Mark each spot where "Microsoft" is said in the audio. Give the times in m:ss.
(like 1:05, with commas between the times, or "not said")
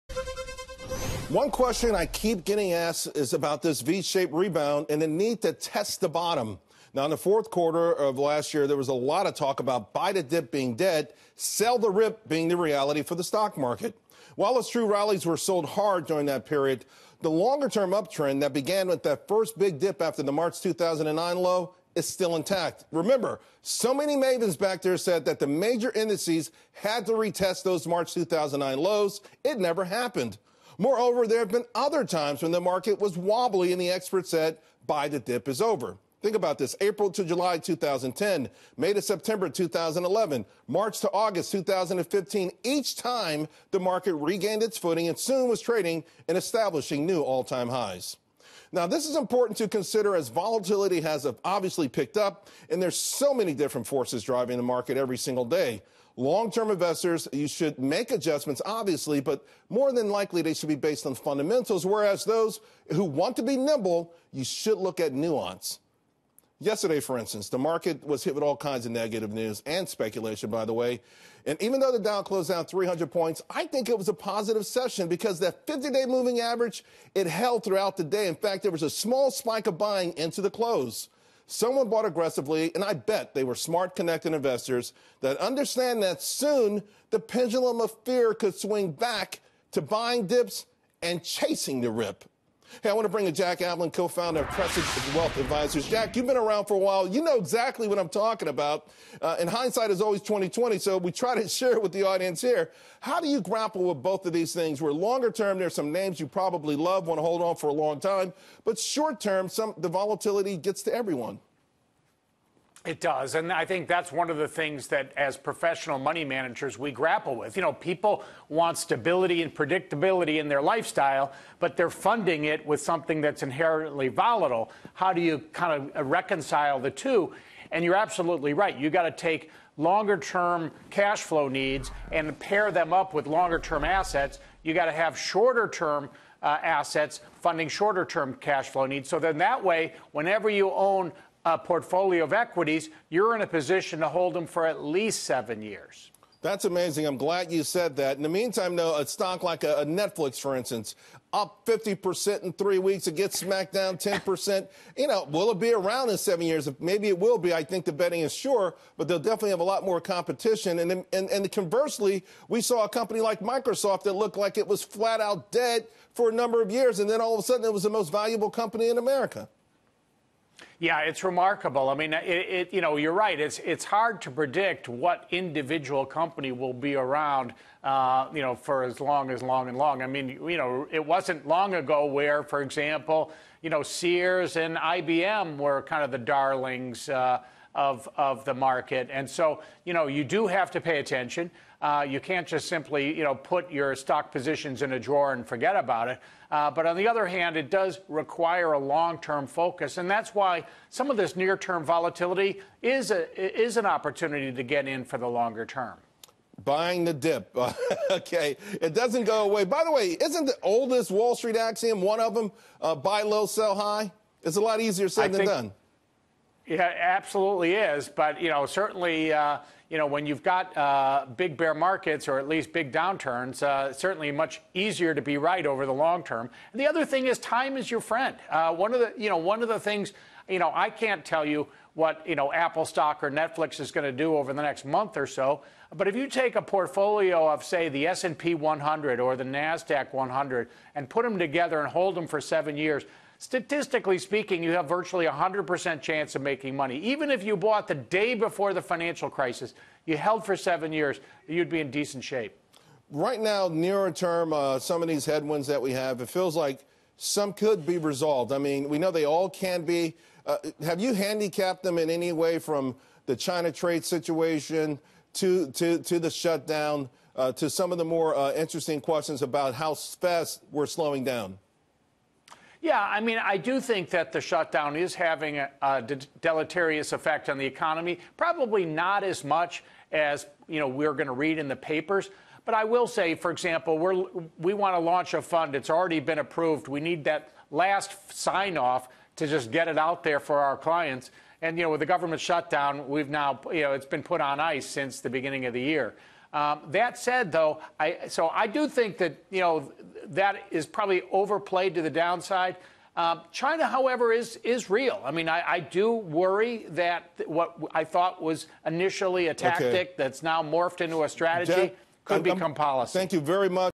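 2:43.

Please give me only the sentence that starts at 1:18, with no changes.
In fact, there was a small spike of buying into the close.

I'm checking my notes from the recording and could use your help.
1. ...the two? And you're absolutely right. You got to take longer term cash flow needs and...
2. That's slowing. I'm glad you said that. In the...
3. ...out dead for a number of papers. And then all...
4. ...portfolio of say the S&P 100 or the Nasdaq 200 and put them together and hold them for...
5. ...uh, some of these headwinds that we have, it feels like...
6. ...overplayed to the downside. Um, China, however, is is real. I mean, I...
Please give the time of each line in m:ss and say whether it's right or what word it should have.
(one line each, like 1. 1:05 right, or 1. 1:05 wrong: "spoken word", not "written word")
1. 2:06 right
2. 2:26 wrong: "amazing", not "slowing"
3. 2:45 wrong: "years", not "papers"
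4. 3:56 wrong: "100", not "200"
5. 4:14 right
6. 5:01 right.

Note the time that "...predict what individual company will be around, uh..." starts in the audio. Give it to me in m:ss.
2:54.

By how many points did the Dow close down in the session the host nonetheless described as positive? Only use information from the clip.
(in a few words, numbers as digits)
300.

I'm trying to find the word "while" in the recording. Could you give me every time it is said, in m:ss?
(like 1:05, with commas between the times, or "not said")
0:14, 1:36.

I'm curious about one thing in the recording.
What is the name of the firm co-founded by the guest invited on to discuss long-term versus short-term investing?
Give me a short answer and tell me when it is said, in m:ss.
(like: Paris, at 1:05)
Cresset Wealth Advisors, at 1:34.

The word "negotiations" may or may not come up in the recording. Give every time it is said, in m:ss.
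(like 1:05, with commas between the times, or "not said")
not said.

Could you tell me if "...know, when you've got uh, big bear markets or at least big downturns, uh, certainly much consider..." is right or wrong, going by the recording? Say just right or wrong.
wrong.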